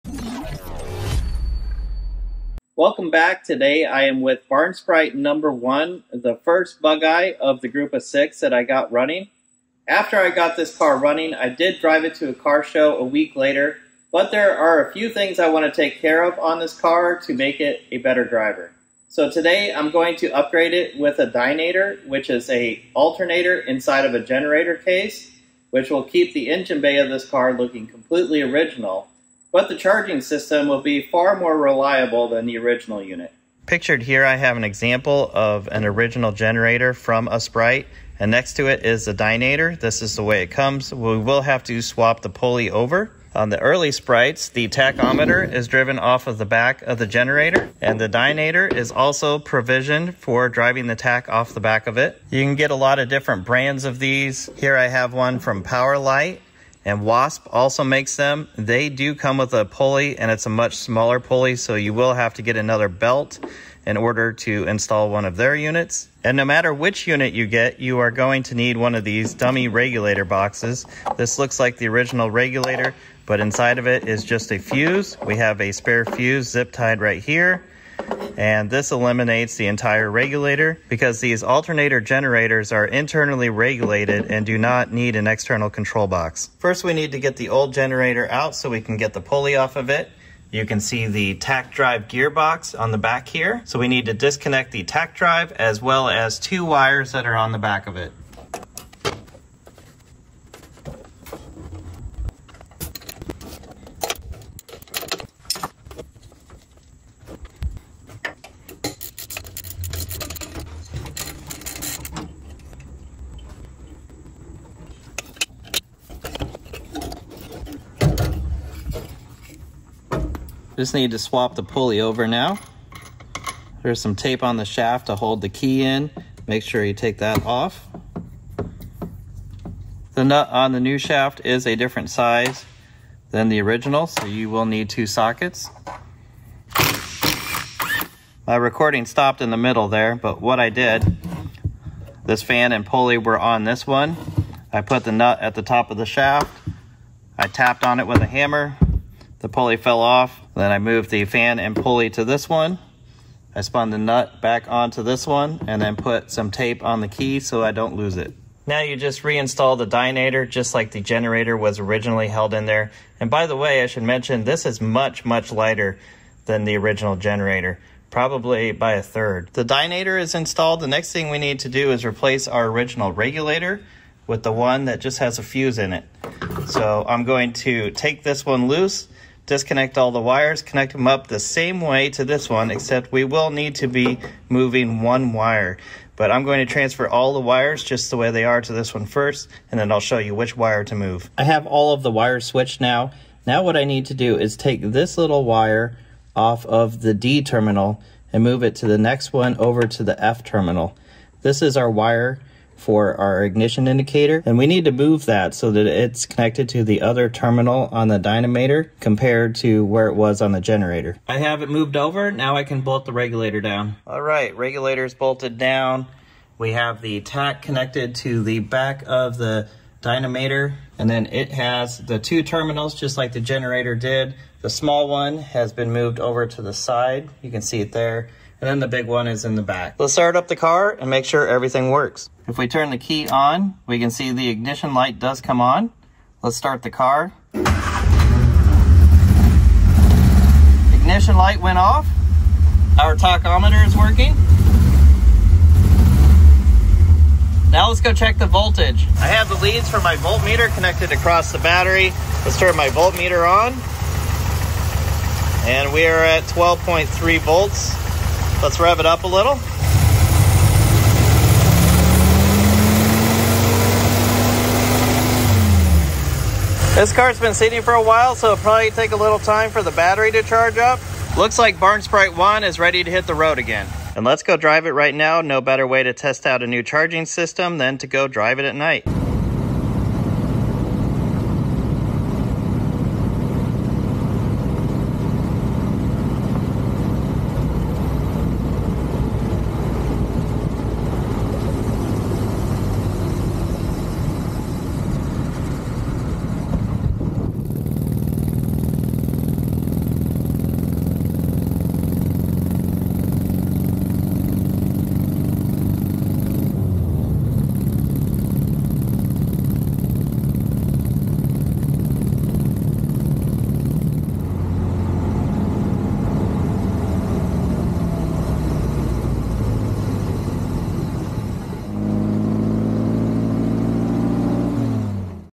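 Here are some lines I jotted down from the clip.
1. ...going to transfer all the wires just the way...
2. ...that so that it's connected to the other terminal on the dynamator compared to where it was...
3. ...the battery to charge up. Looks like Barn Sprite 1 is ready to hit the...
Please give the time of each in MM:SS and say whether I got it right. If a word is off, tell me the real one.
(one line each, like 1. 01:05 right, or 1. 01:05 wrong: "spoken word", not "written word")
1. 03:06 right
2. 03:25 right
3. 04:29 right.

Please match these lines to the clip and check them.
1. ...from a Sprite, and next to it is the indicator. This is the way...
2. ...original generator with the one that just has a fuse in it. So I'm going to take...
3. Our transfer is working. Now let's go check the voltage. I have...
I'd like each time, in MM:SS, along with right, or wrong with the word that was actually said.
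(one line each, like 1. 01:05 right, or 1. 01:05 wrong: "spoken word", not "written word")
1. 00:36 wrong: "dynamator", not "indicator"
2. 02:52 wrong: "regulator", not "generator"
3. 04:02 wrong: "tachometer", not "transfer".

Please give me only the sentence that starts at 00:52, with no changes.
You can get a lot of different brands of these.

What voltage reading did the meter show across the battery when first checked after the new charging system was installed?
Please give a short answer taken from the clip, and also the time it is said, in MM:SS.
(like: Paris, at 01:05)
12.3 volts, at 04:16.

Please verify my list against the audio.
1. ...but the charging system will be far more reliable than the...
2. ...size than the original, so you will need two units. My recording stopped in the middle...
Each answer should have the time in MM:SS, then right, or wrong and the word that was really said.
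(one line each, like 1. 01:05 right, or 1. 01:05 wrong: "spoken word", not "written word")
1. 00:29 right
2. 02:12 wrong: "sockets", not "units".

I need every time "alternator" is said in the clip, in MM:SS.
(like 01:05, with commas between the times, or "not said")
00:22, 01:21.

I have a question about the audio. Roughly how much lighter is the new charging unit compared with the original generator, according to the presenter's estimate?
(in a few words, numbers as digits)
a third.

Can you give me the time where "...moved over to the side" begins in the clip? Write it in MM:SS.
03:45.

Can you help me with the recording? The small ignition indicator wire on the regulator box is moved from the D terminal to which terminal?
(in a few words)
F terminal.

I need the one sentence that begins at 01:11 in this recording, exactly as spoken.
This looks like the original regulator, but inside of it is just a fuse.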